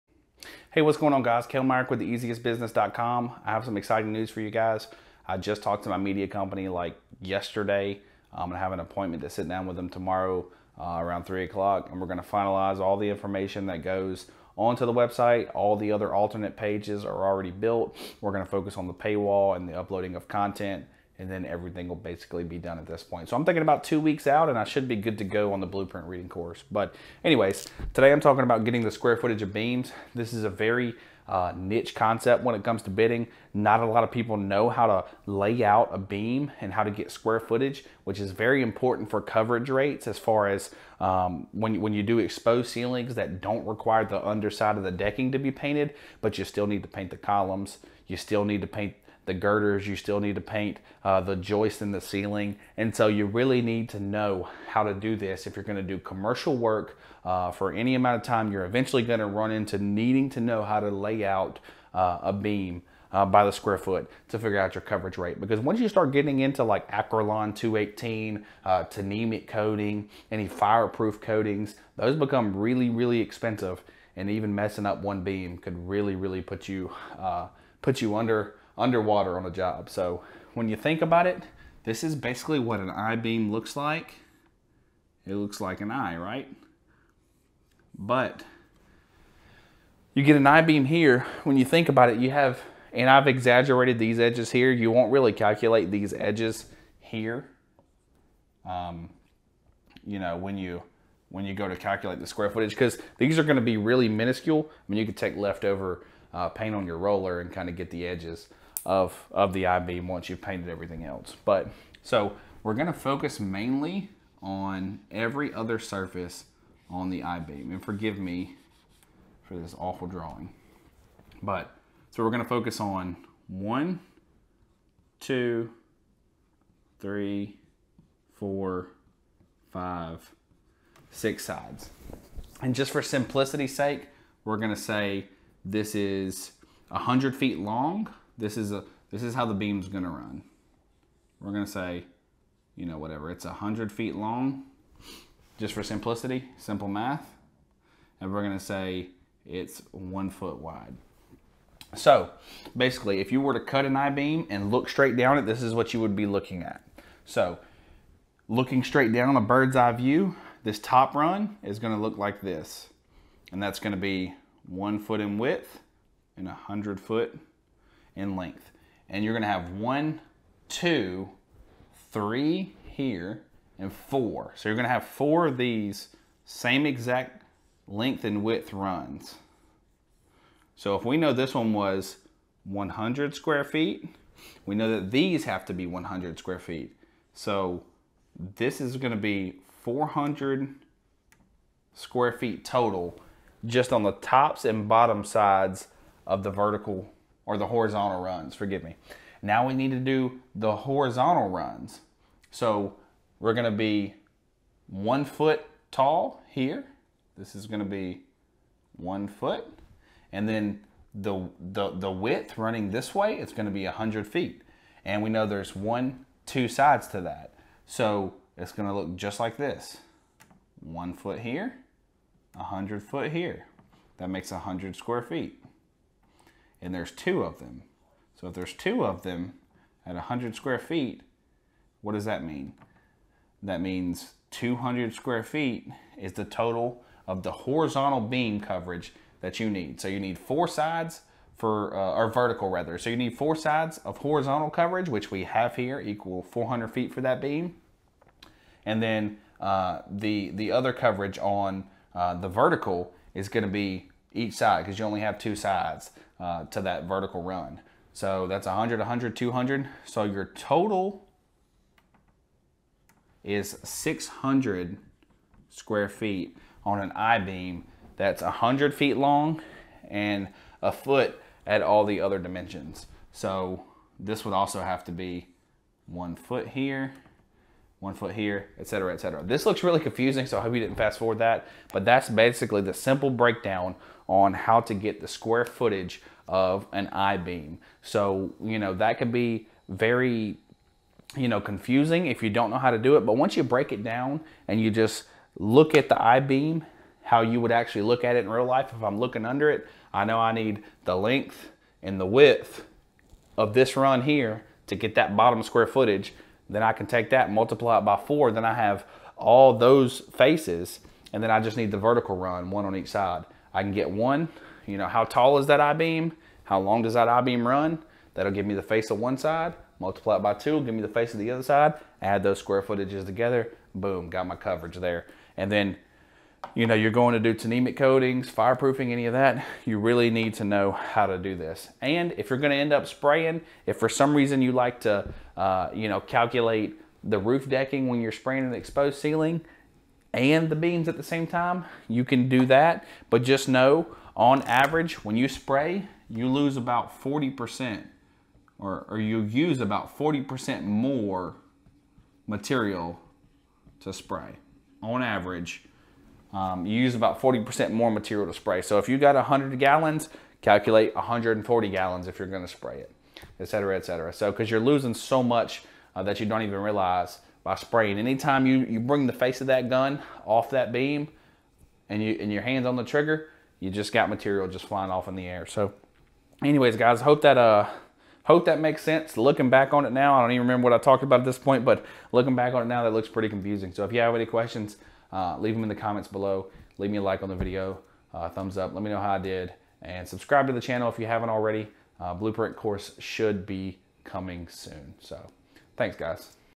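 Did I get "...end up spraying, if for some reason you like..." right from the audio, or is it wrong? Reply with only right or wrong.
right.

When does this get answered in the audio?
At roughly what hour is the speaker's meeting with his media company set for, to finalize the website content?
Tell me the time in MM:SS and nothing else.
00:11.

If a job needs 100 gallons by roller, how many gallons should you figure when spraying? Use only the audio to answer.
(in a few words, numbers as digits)
140 gallons.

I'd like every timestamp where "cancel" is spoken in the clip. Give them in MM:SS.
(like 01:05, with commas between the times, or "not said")
not said.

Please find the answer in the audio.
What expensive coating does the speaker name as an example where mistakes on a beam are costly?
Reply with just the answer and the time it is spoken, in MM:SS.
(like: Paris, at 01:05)
Acrolon 218, at 01:06.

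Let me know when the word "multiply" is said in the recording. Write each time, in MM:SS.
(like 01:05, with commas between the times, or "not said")
05:07, 05:19.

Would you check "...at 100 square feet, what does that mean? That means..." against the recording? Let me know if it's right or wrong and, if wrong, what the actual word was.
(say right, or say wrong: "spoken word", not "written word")
right.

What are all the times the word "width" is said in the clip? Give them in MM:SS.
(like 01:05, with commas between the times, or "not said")
02:45, 02:58, 03:32, 05:02.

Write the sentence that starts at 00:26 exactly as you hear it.
But anyways, today I'm talking about getting the square footage of beams.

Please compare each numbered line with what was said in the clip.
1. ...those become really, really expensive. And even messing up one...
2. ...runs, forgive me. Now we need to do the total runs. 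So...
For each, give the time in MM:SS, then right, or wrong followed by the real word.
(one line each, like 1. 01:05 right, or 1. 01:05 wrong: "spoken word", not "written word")
1. 01:11 right
2. 03:18 wrong: "horizontal", not "total".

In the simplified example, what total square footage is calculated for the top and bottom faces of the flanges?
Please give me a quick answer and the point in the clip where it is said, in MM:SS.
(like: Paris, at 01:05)
400 square feet, at 03:09.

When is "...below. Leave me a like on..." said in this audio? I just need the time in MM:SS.
06:26.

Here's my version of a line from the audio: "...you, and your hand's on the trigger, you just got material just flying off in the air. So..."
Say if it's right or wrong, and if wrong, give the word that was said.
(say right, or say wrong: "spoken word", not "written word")
right.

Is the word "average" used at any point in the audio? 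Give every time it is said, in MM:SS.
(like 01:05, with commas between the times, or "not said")
05:44, 05:55.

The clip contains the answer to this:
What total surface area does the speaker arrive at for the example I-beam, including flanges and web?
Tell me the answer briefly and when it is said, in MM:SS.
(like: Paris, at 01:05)
600 square feet, at 04:23.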